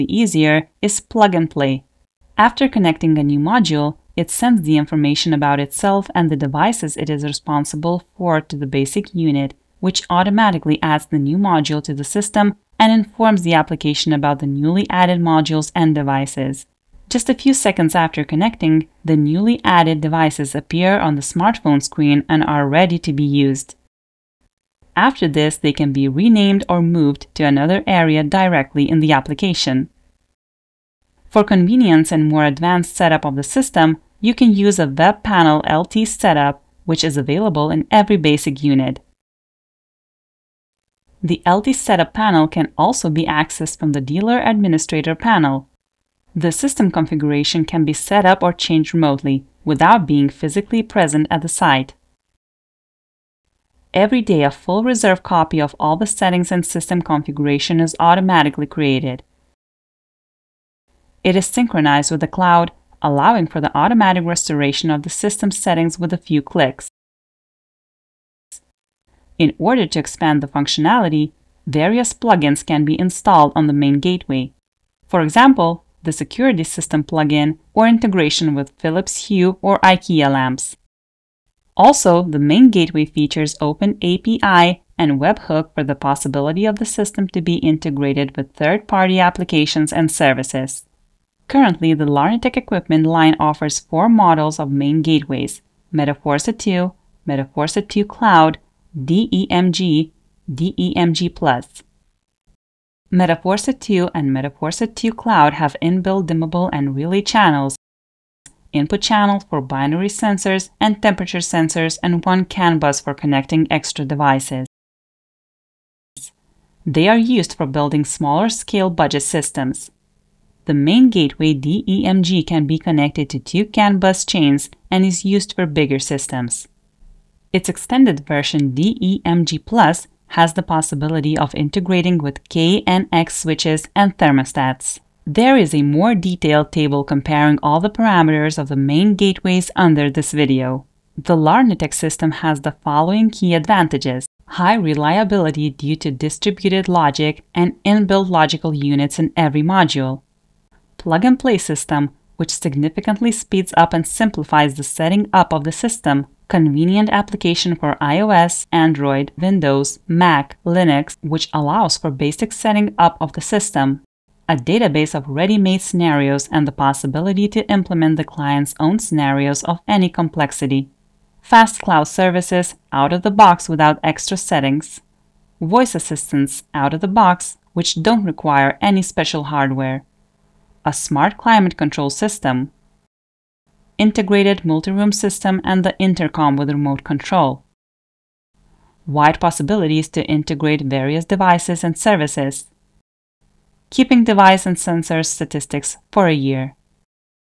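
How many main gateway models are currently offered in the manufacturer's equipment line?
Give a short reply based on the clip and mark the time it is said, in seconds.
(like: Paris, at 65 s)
4, at 93 s.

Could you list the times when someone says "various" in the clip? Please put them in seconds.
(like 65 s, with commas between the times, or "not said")
71 s, 190 s.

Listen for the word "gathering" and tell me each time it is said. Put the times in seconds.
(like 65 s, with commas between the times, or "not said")
not said.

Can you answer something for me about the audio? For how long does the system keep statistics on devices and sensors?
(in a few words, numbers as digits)
A year.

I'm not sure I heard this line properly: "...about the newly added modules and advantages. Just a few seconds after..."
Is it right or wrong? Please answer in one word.
wrong.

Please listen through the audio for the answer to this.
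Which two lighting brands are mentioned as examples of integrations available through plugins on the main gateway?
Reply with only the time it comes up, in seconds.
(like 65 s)
78 s.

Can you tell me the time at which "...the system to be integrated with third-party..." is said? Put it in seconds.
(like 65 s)
86 s.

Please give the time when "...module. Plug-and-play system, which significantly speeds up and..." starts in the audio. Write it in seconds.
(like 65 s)
149 s.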